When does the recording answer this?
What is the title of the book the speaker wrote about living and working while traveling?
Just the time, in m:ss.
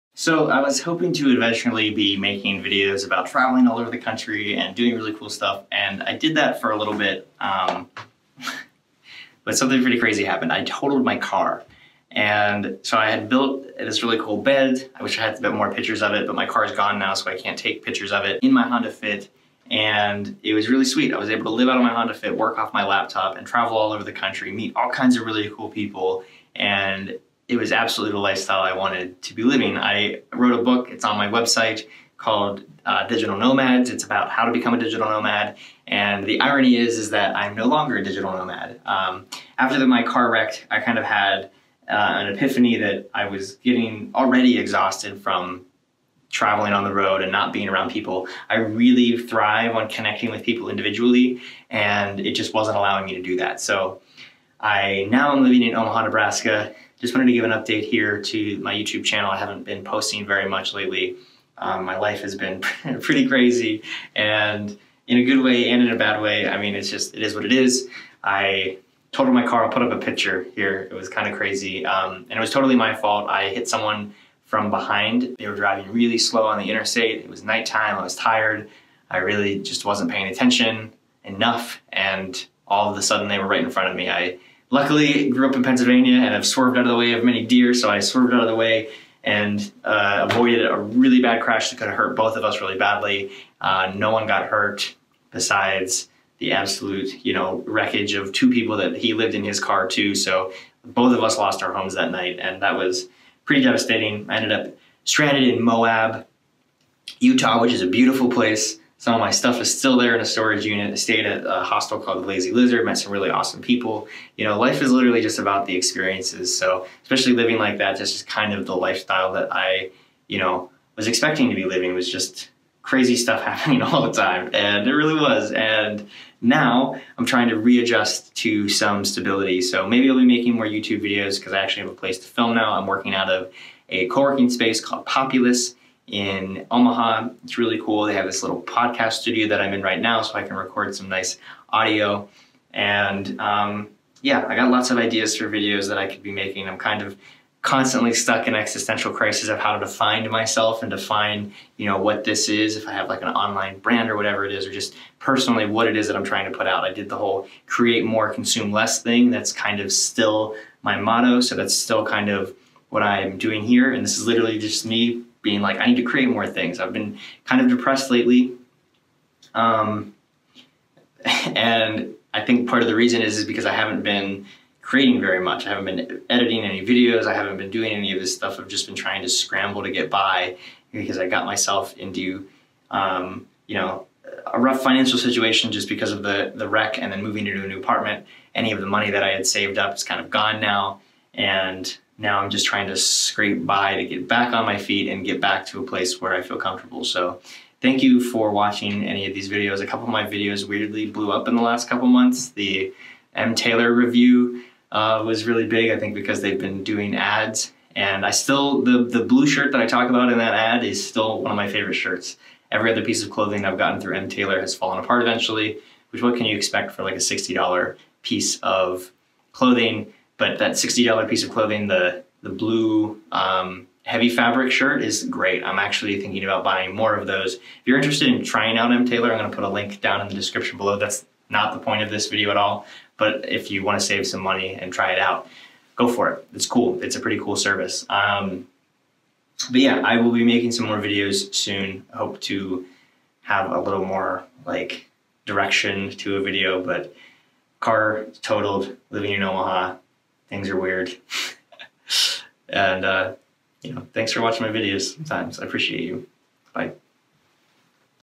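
0:33.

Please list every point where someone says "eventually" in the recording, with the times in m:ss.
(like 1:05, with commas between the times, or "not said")
0:01, 3:35.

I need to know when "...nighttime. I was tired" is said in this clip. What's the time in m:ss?
1:17.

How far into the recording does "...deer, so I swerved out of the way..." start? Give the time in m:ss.
1:27.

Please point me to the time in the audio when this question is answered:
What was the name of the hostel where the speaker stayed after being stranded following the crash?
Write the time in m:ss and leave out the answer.
1:52.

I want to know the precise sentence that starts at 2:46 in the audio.
I've been kind of depressed lately.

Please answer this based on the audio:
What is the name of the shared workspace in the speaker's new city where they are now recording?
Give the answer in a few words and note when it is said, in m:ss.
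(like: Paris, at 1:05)
Populus, at 2:15.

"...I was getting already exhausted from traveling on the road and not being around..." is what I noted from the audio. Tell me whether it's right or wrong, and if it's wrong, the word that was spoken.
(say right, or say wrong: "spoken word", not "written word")
right.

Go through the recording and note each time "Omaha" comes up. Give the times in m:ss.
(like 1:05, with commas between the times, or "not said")
0:55, 2:16, 4:09.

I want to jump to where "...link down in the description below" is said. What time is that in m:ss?
3:49.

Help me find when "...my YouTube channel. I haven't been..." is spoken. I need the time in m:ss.
0:58.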